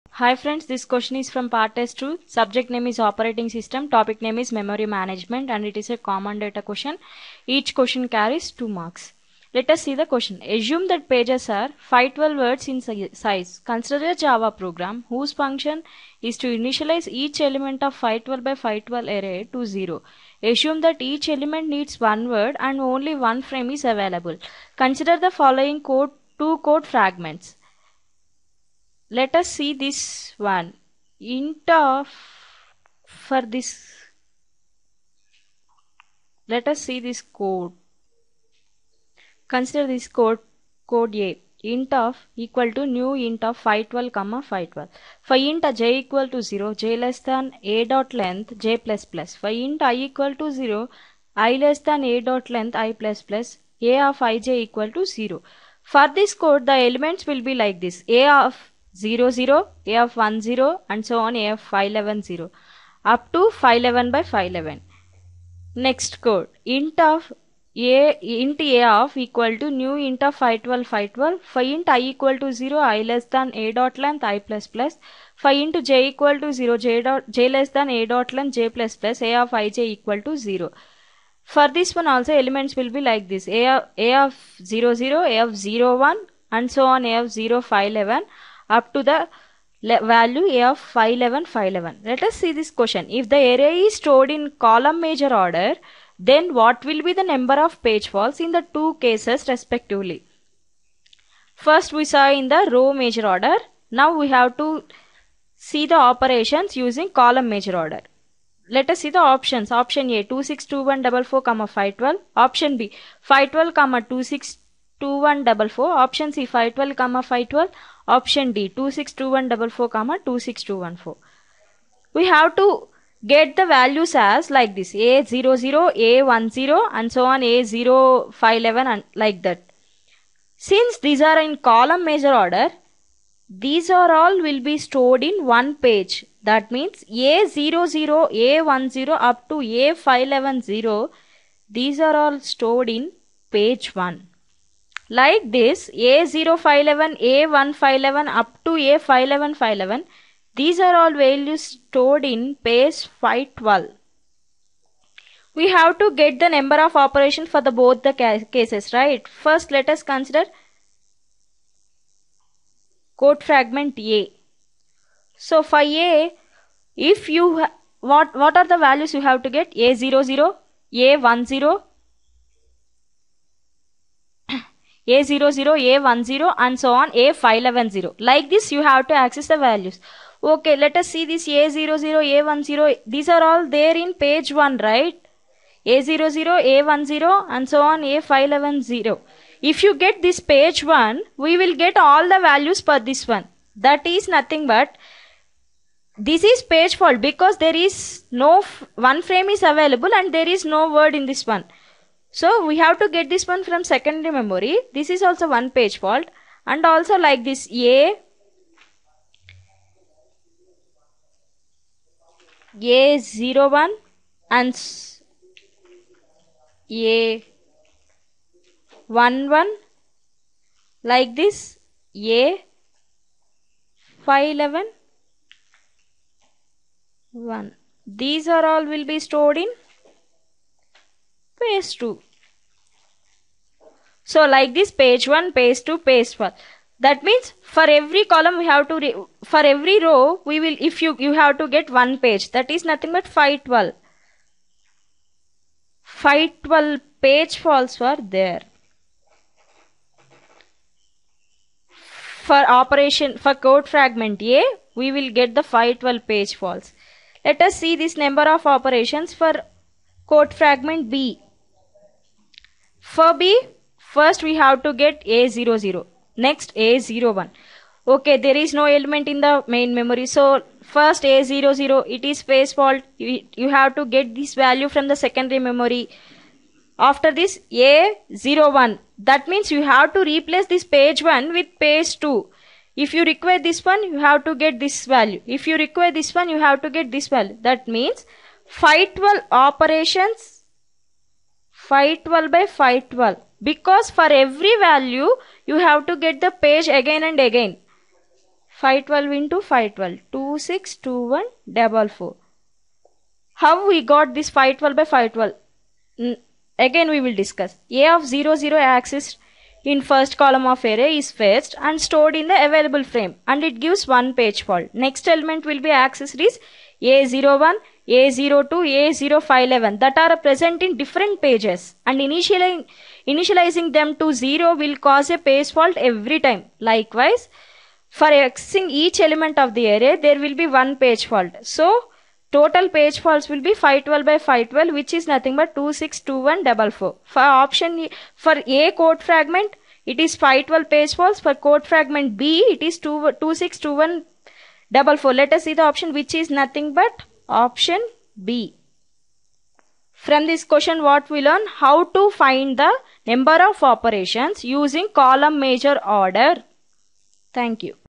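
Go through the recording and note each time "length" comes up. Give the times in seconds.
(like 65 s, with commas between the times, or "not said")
48 s, 52 s, 74 s, 78 s.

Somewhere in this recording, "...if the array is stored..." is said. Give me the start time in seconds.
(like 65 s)
93 s.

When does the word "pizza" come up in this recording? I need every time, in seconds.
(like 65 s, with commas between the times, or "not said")
not said.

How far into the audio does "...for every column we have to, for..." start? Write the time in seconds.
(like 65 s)
237 s.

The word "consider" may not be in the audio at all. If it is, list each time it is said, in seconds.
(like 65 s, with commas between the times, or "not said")
13 s, 24 s, 39 s, 160 s.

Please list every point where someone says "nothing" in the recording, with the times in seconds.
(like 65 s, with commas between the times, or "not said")
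194 s, 242 s, 335 s, 346 s.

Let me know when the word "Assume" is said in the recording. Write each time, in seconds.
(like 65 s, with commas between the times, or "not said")
10 s, 20 s.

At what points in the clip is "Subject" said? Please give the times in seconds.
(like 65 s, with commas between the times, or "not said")
2 s.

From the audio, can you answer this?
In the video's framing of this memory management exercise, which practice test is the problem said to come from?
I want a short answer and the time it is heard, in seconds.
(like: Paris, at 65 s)
Part test 2, at 1 s.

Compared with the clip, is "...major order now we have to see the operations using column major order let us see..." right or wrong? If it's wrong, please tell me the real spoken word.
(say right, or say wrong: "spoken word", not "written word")
right.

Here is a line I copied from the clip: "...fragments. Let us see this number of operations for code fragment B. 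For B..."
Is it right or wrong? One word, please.
wrong.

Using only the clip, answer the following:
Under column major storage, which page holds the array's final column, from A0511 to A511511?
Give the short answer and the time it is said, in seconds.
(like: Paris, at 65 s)
Page 512, at 152 s.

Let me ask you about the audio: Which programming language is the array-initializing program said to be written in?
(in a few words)
Java.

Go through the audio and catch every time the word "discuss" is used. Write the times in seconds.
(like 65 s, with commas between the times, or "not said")
307 s.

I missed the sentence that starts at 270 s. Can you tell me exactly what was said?
So first A00, it is page fault.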